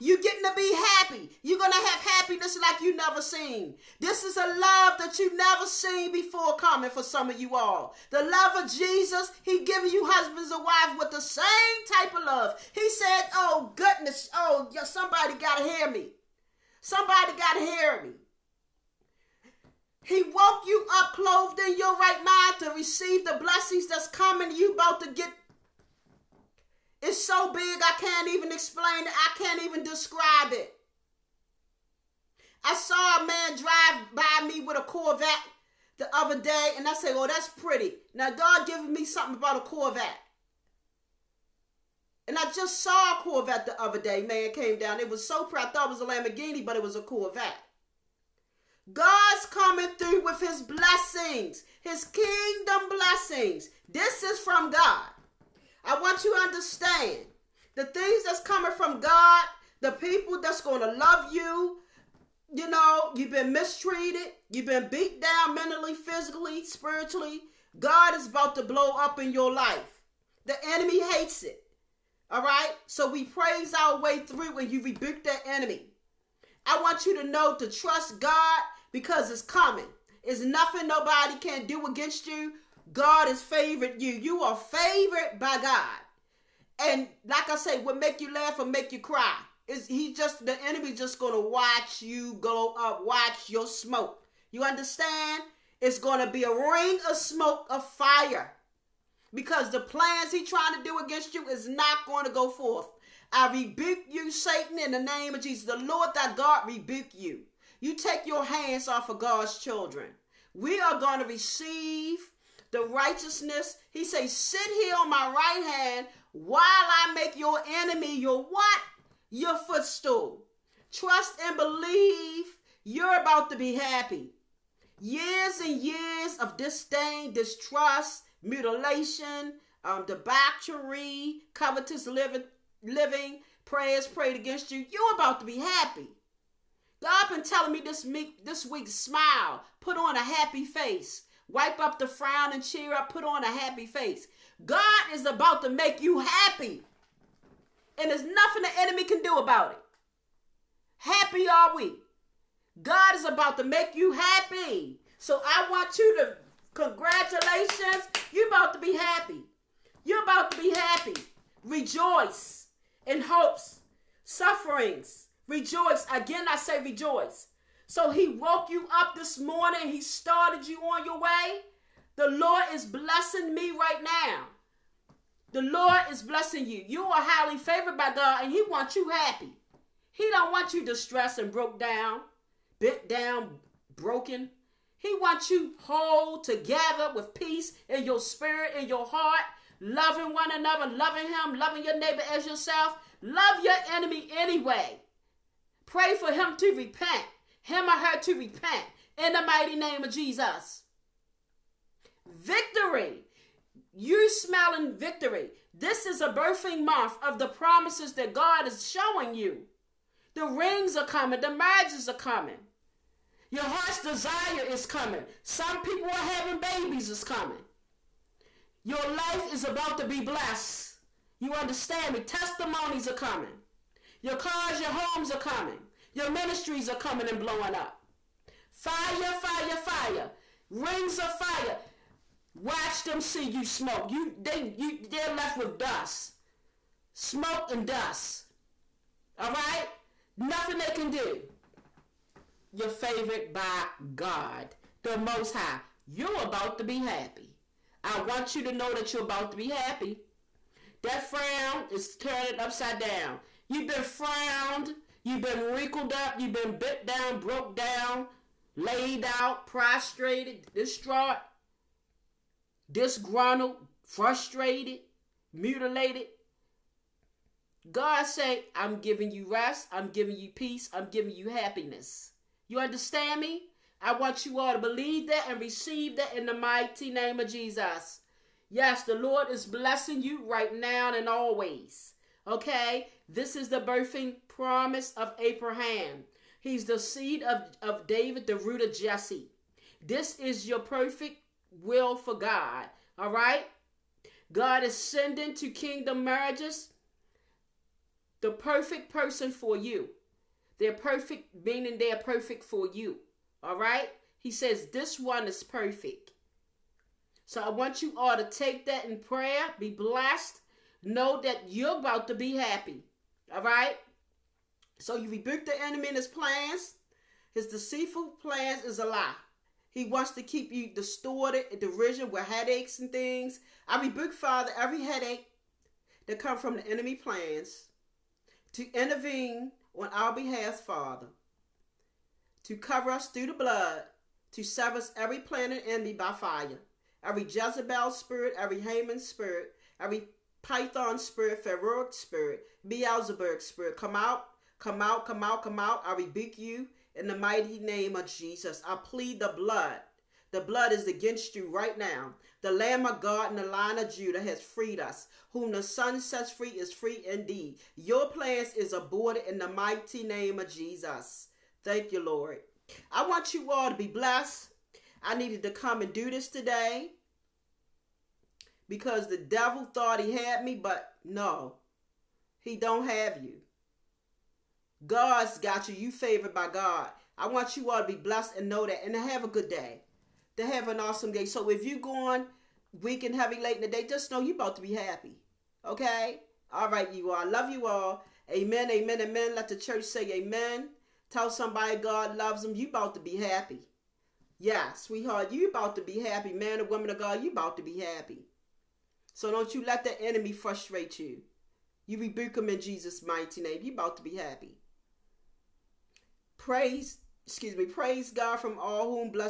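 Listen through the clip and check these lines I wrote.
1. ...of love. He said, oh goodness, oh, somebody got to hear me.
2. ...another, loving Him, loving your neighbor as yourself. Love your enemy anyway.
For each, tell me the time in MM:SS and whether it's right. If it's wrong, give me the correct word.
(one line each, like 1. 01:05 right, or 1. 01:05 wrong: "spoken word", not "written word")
1. 00:12 right
2. 03:10 right.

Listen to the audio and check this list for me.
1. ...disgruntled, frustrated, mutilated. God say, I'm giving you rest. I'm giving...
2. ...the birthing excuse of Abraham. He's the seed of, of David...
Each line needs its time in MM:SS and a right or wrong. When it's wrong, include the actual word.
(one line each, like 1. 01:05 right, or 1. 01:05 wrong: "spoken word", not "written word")
1. 04:22 right
2. 04:43 wrong: "promise", not "excuse".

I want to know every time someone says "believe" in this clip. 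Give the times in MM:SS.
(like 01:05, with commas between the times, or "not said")
02:01, 04:34.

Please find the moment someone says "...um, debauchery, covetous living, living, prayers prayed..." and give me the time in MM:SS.
02:09.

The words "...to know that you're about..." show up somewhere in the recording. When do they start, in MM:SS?
04:08.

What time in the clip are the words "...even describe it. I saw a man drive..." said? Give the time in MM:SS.
00:29.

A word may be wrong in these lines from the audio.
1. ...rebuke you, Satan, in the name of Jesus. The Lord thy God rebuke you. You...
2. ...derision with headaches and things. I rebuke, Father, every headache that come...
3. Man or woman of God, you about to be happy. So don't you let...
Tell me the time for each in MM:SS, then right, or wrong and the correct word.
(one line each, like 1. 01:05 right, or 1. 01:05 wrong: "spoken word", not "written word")
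1. 01:43 right
2. 05:21 right
3. 06:36 right.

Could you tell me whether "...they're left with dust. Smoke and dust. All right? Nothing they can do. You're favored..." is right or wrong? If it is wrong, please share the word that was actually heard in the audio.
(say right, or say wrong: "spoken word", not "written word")
right.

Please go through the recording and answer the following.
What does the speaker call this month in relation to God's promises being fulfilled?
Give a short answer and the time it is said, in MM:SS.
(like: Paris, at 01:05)
Birthing month, at 03:26.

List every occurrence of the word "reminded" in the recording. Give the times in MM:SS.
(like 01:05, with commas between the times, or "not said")
not said.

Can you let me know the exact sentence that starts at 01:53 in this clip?
He say, sit here on my right hand while I make your enemy your what?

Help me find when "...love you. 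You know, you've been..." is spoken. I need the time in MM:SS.
01:00.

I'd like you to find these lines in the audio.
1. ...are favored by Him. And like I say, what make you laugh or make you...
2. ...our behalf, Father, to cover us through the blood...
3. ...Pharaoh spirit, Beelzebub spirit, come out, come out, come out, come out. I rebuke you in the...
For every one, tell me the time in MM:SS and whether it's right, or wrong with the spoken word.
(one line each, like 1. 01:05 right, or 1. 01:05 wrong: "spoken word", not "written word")
1. 01:24 wrong: "God", not "Him"
2. 05:30 right
3. 05:41 right.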